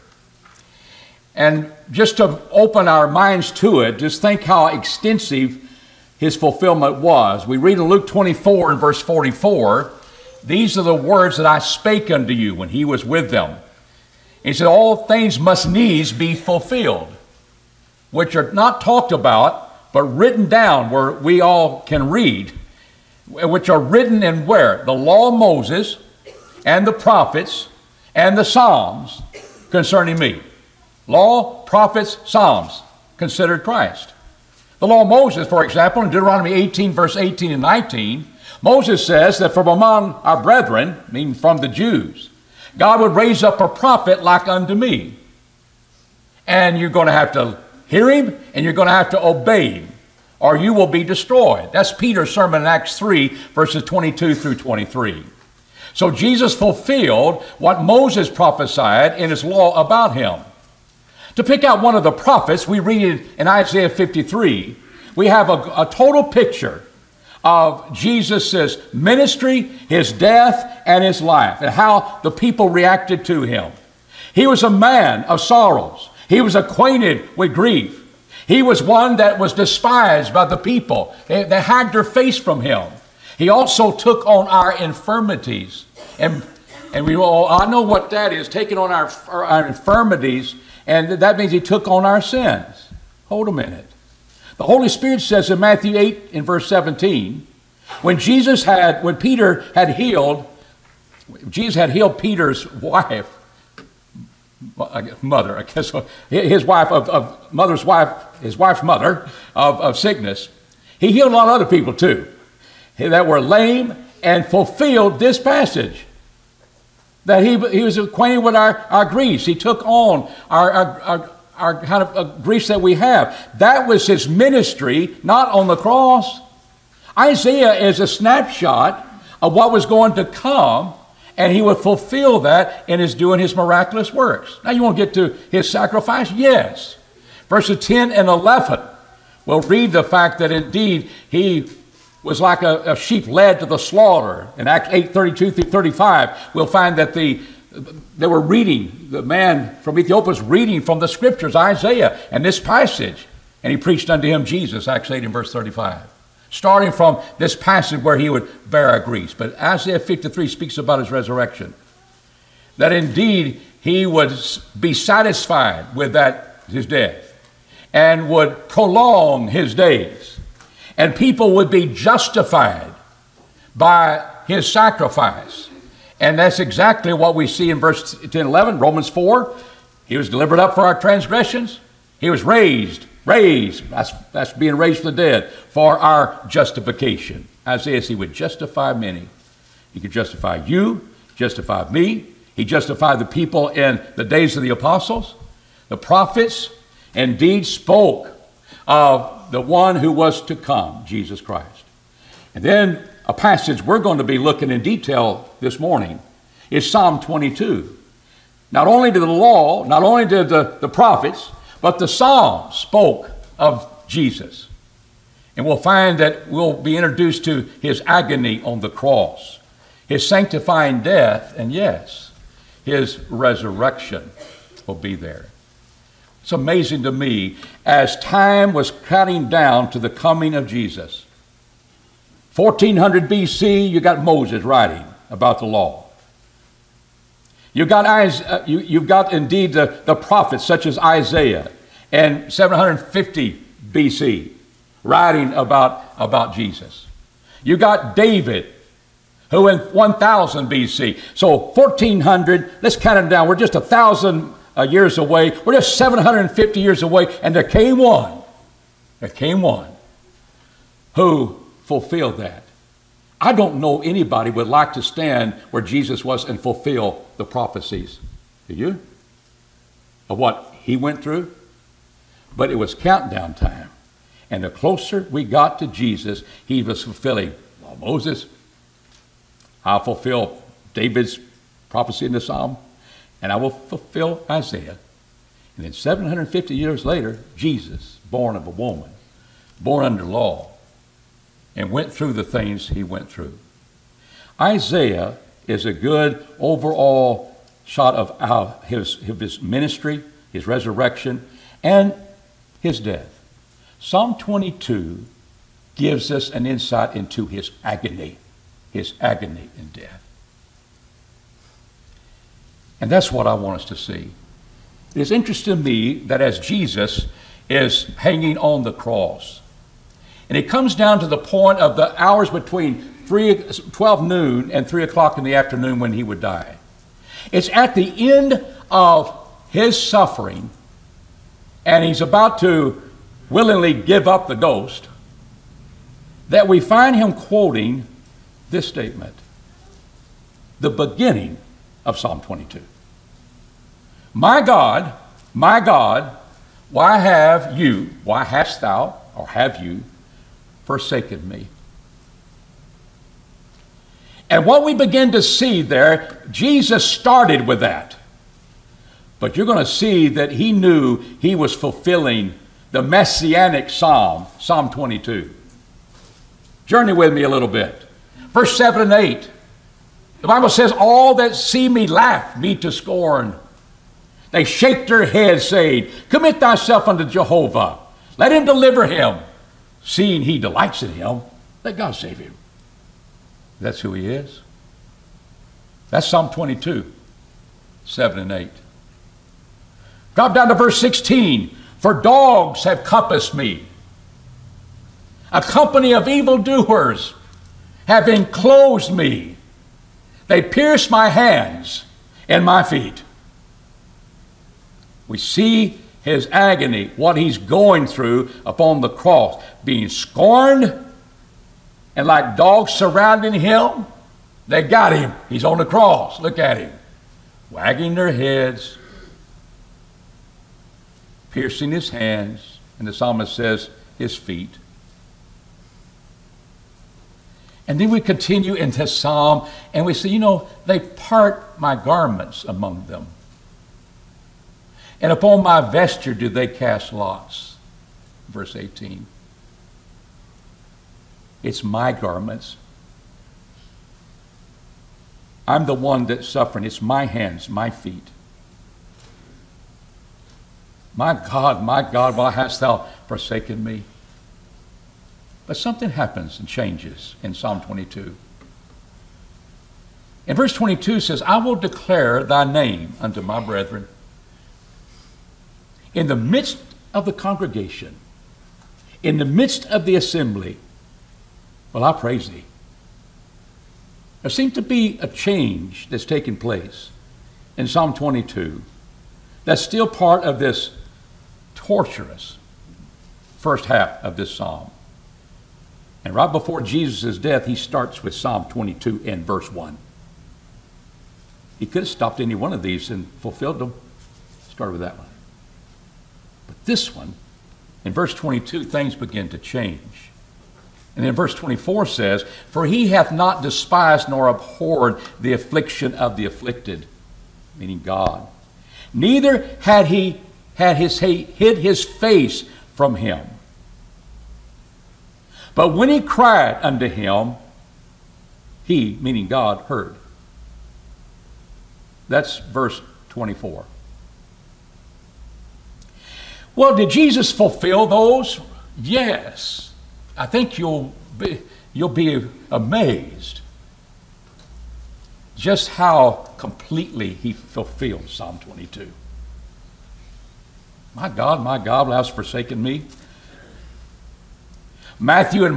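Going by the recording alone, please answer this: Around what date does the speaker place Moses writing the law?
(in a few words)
1400 BC.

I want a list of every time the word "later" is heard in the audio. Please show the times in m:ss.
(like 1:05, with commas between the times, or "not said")
4:47.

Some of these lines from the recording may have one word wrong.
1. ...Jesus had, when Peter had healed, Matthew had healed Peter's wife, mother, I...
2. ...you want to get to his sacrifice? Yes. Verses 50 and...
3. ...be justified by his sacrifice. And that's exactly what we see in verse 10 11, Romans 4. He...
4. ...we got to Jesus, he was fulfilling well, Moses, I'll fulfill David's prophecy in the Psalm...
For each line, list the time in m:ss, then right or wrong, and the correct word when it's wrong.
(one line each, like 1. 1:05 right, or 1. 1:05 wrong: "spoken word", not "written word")
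1. 1:38 wrong: "Jesus", not "Matthew"
2. 2:14 wrong: "10", not "50"
3. 2:51 right
4. 4:35 right.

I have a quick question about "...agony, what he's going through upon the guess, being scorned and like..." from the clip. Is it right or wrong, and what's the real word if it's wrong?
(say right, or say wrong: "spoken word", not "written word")
wrong: "cross", not "guess".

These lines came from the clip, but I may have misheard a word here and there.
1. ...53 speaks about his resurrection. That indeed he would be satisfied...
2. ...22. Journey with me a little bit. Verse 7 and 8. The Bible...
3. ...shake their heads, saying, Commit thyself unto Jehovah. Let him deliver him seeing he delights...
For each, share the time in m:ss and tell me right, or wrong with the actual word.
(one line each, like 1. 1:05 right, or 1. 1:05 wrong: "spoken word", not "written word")
1. 2:39 right
2. 6:04 right
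3. 6:14 right.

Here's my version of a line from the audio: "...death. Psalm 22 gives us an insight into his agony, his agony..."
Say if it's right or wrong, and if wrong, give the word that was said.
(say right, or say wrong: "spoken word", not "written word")
right.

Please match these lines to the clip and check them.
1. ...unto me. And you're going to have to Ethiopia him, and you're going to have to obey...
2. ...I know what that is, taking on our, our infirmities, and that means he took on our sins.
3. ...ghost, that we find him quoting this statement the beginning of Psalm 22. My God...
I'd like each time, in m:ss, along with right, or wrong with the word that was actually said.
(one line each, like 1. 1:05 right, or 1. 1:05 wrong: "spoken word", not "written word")
1. 0:44 wrong: "Hear", not "Ethiopia"
2. 1:27 right
3. 5:34 right.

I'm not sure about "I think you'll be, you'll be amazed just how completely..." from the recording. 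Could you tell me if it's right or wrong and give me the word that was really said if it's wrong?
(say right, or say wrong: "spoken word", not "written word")
right.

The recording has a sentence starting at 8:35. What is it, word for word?
But when he cried unto him, he, meaning God, heard.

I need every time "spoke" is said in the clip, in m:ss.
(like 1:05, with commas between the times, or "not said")
3:17, 3:32.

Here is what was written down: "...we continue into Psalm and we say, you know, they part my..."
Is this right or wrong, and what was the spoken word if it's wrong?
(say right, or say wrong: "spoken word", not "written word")
right.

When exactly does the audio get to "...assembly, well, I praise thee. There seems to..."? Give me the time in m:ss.
7:50.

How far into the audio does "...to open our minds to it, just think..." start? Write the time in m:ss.
0:02.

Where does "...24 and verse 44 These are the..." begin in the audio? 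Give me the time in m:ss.
0:08.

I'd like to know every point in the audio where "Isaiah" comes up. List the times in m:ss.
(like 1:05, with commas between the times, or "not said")
1:03, 2:07, 2:31, 2:39, 3:07, 4:00, 4:44, 4:54.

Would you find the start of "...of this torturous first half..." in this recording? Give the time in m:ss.
8:00.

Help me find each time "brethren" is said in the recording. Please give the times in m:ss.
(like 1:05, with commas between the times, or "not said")
0:40, 7:43.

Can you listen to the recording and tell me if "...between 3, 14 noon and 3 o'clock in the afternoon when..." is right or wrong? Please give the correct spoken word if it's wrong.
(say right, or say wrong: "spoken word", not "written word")
wrong: "12", not "14".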